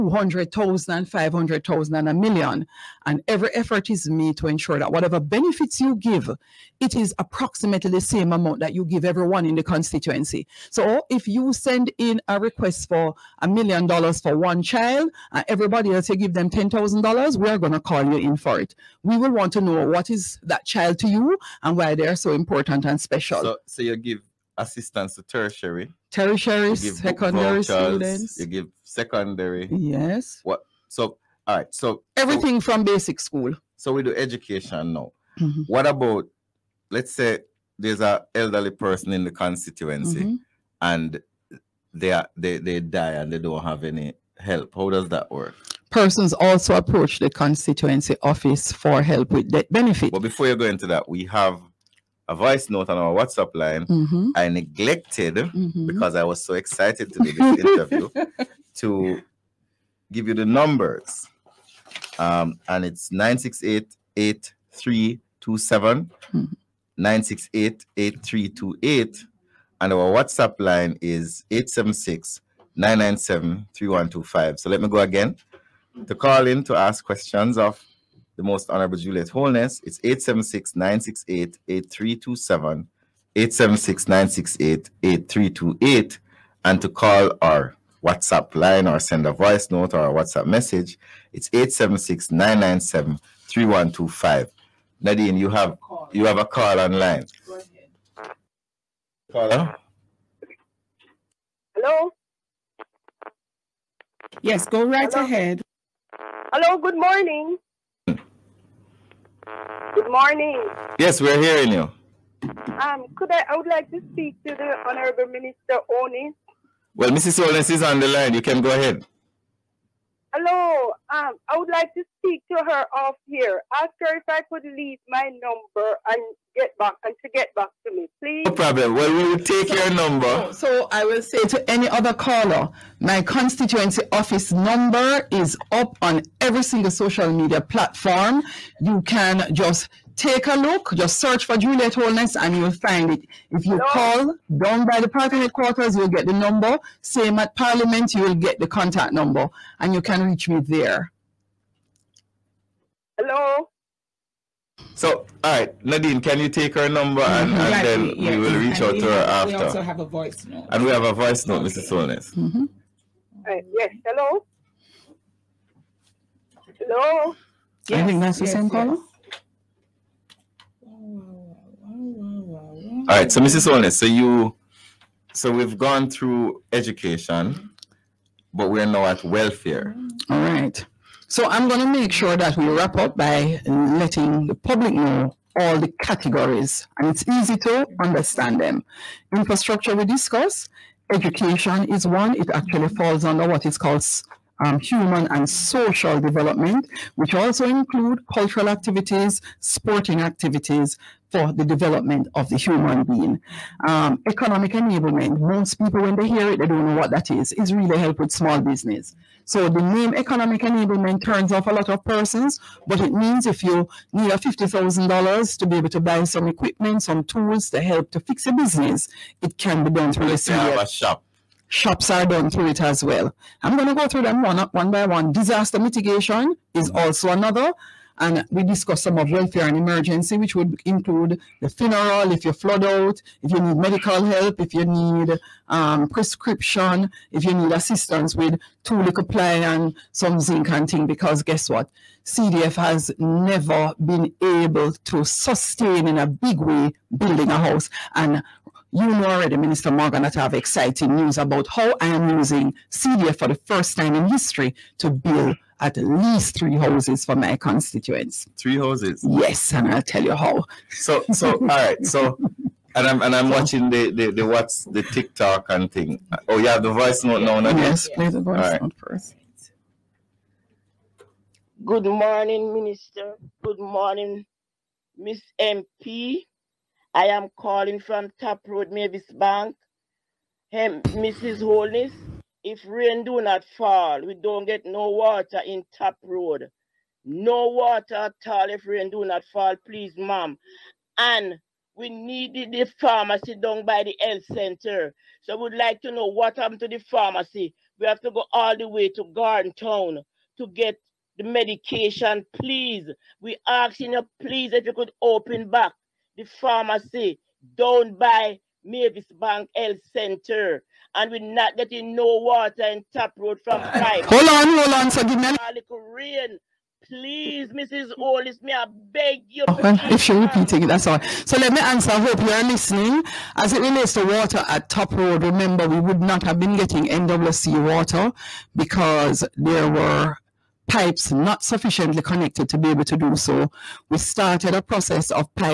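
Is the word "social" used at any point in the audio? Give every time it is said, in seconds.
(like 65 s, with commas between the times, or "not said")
136 s, 195 s.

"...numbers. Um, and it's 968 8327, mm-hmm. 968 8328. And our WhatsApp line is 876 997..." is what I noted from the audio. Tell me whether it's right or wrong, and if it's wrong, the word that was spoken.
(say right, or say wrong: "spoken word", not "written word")
right.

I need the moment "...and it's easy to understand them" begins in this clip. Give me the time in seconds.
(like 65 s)
186 s.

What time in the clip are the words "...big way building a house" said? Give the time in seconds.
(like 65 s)
246 s.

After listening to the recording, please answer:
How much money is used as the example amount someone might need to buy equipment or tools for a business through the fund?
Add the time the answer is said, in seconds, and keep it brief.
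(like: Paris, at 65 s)
$50,000, at 214 s.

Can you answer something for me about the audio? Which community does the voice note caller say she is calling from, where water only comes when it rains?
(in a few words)
Top Road, Mavis Bank.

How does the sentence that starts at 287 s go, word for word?
No water at all if rain do not fall, please, ma'am.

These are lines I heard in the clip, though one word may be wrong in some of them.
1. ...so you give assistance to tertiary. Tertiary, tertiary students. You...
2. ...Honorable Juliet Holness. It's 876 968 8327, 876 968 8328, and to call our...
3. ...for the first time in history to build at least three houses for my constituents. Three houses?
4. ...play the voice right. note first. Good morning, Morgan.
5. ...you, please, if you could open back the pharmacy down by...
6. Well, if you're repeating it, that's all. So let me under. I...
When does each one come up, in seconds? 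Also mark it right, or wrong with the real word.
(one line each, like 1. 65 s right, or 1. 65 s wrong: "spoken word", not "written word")
1. 23 s wrong: "secondary", not "tertiary"
2. 78 s right
3. 253 s right
4. 268 s wrong: "Minister", not "Morgan"
5. 304 s right
6. 319 s wrong: "answer", not "under".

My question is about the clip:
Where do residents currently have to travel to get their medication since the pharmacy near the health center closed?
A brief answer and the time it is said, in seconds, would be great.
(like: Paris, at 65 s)
Gordon Town, at 299 s.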